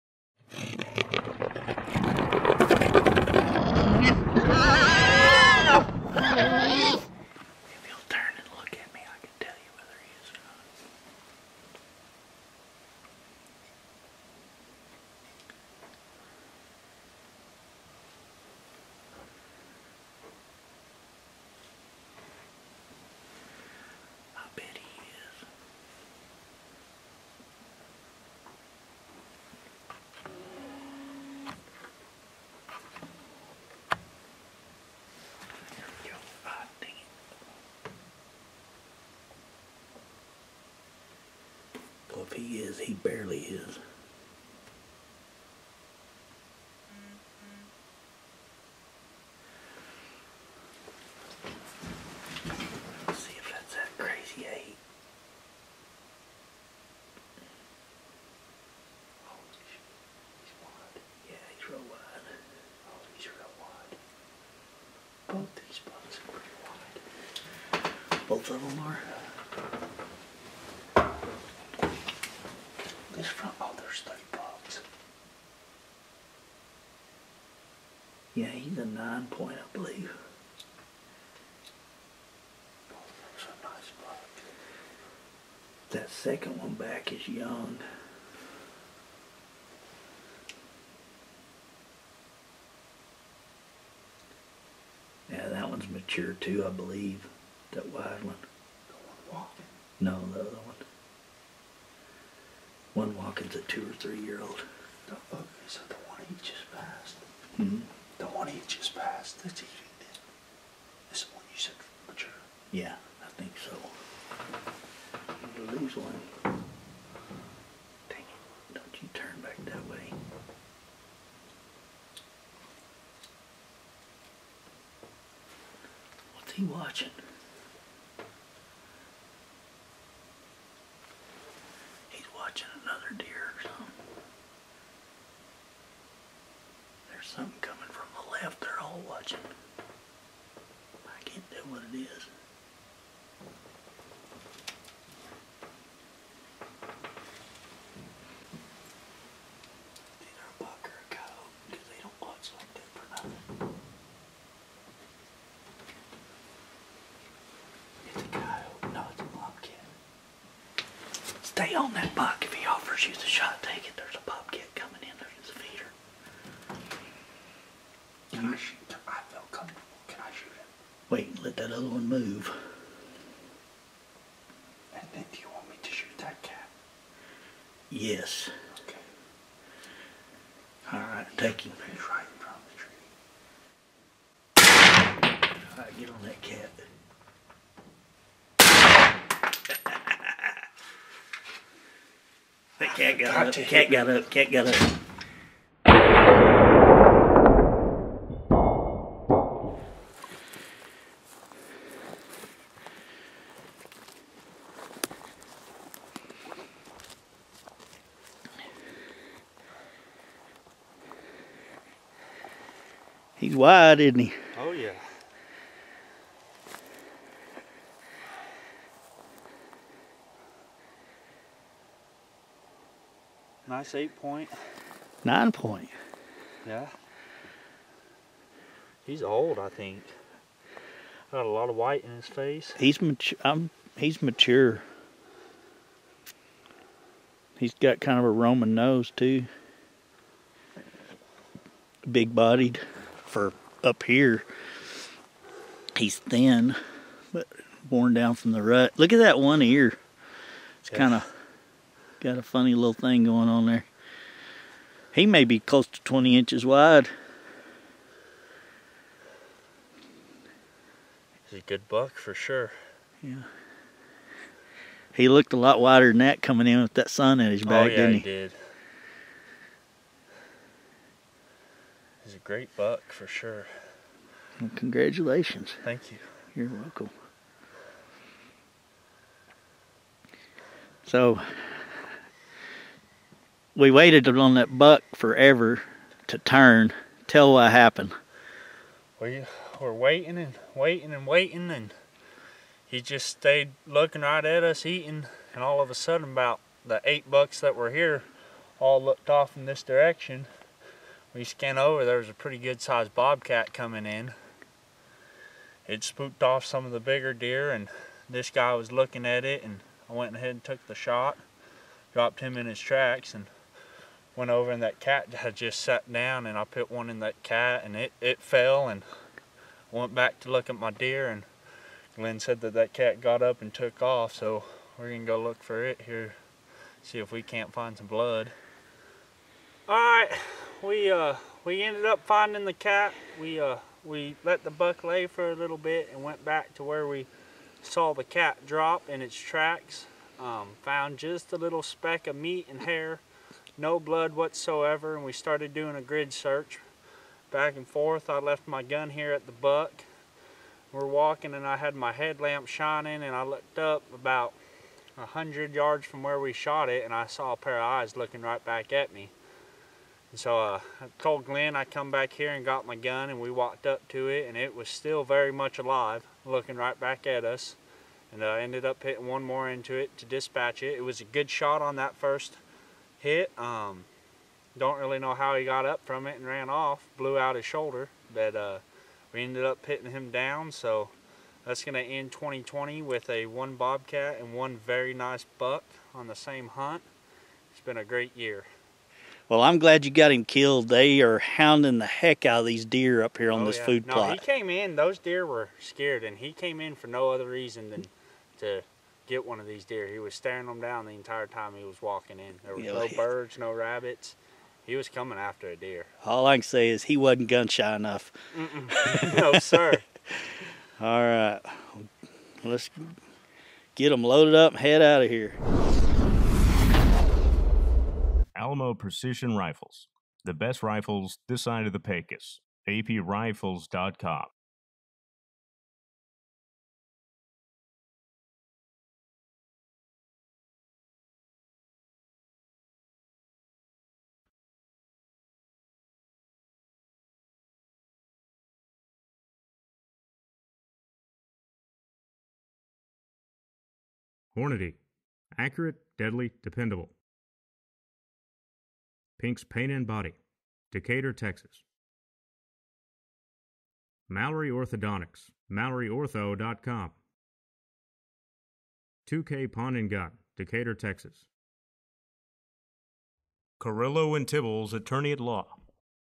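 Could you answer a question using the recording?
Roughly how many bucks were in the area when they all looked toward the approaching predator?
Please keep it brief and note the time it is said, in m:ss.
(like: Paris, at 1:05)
8, at 4:57.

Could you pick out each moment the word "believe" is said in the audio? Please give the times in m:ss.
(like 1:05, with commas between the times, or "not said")
1:19, 1:36.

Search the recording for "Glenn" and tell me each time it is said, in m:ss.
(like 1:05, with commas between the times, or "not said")
5:22, 6:01.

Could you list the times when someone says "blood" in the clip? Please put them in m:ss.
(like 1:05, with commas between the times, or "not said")
5:28, 5:43.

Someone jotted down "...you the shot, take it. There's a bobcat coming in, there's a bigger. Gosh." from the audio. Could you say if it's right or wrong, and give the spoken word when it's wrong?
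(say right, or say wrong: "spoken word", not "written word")
wrong: "feeder", not "bigger".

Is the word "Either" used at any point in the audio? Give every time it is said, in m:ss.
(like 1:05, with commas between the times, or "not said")
2:30.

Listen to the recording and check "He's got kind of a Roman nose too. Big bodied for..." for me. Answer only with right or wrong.
right.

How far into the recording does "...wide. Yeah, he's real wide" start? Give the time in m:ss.
1:00.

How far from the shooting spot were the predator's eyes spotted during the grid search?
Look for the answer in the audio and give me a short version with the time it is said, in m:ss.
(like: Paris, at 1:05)
100 yards, at 5:55.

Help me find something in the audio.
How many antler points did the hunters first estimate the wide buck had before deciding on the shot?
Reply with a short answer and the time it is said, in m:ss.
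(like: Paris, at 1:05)
9 point, at 1:18.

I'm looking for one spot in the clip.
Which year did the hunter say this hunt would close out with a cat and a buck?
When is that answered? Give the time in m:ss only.
6:22.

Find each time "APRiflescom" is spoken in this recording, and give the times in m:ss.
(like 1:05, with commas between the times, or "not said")
7:02.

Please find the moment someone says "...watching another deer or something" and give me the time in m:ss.
2:12.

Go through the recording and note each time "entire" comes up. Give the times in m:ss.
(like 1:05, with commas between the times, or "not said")
6:41.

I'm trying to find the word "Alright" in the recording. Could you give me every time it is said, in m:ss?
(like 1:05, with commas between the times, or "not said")
3:00, 3:05.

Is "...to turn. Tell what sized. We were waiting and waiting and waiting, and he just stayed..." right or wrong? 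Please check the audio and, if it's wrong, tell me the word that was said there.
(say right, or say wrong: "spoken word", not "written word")
wrong: "happened", not "sized".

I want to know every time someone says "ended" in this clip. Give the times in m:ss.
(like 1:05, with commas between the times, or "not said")
5:31, 6:08, 6:19.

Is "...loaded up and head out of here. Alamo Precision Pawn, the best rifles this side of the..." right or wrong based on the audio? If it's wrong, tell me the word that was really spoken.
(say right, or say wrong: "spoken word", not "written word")
wrong: "Rifles", not "Pawn".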